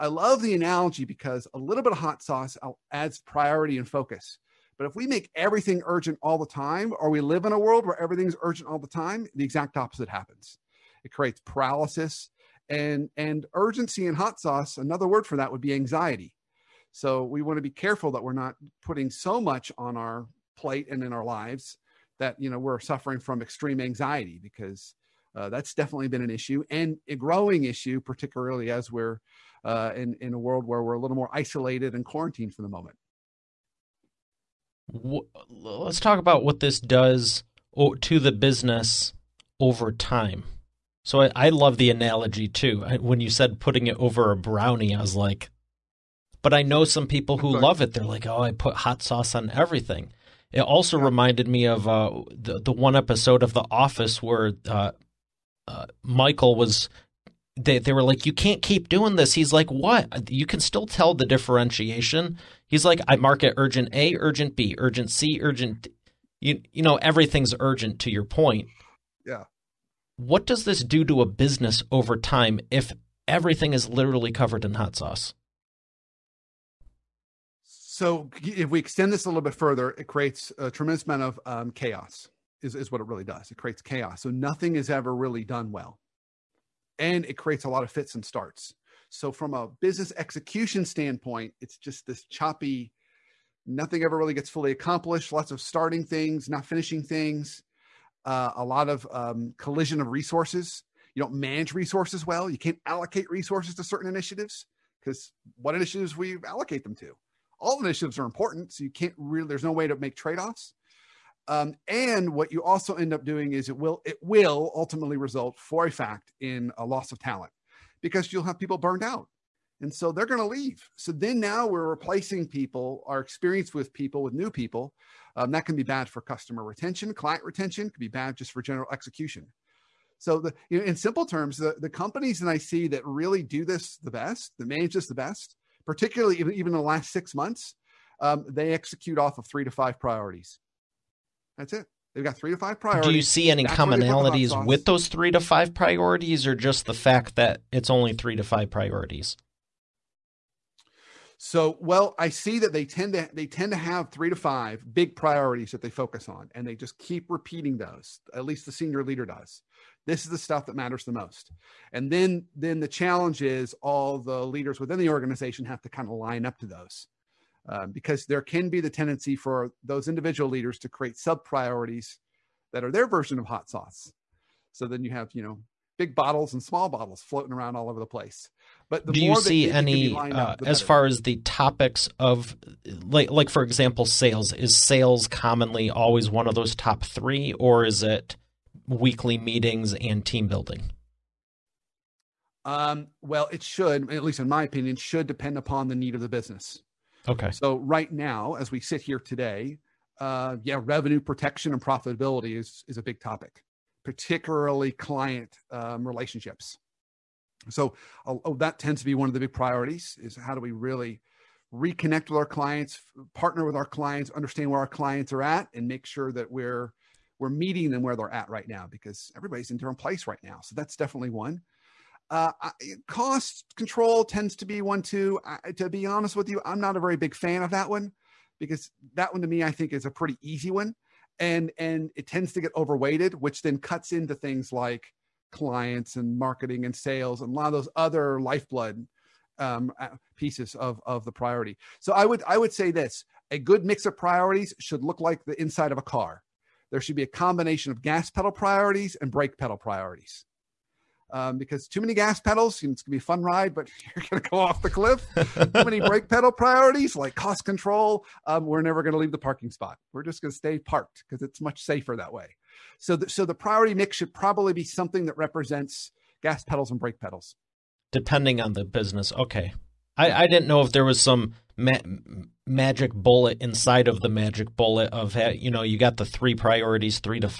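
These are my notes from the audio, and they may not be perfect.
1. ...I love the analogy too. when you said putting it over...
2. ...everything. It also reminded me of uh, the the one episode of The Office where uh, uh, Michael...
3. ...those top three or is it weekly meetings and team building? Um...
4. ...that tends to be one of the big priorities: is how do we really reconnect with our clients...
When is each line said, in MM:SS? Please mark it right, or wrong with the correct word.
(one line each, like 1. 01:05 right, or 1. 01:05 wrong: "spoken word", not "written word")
1. 00:41 right
2. 00:49 right
3. 03:06 right
4. 03:28 right.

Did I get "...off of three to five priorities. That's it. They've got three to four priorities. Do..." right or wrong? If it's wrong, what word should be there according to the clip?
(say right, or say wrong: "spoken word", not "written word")
wrong: "five", not "four".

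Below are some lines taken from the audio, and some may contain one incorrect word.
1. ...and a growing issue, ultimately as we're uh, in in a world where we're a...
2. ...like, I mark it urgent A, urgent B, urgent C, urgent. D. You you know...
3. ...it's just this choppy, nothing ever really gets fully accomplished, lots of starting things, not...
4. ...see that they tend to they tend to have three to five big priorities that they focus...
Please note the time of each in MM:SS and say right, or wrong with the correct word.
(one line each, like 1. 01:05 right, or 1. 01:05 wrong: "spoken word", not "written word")
1. 00:26 wrong: "particularly", not "ultimately"
2. 01:02 right
3. 01:31 right
4. 02:32 right.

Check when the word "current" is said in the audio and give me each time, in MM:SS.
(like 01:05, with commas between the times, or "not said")
not said.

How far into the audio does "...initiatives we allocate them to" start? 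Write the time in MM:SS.
01:45.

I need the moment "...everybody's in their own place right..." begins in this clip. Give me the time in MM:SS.
03:39.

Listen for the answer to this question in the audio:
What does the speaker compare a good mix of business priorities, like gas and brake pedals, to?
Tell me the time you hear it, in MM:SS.
04:05.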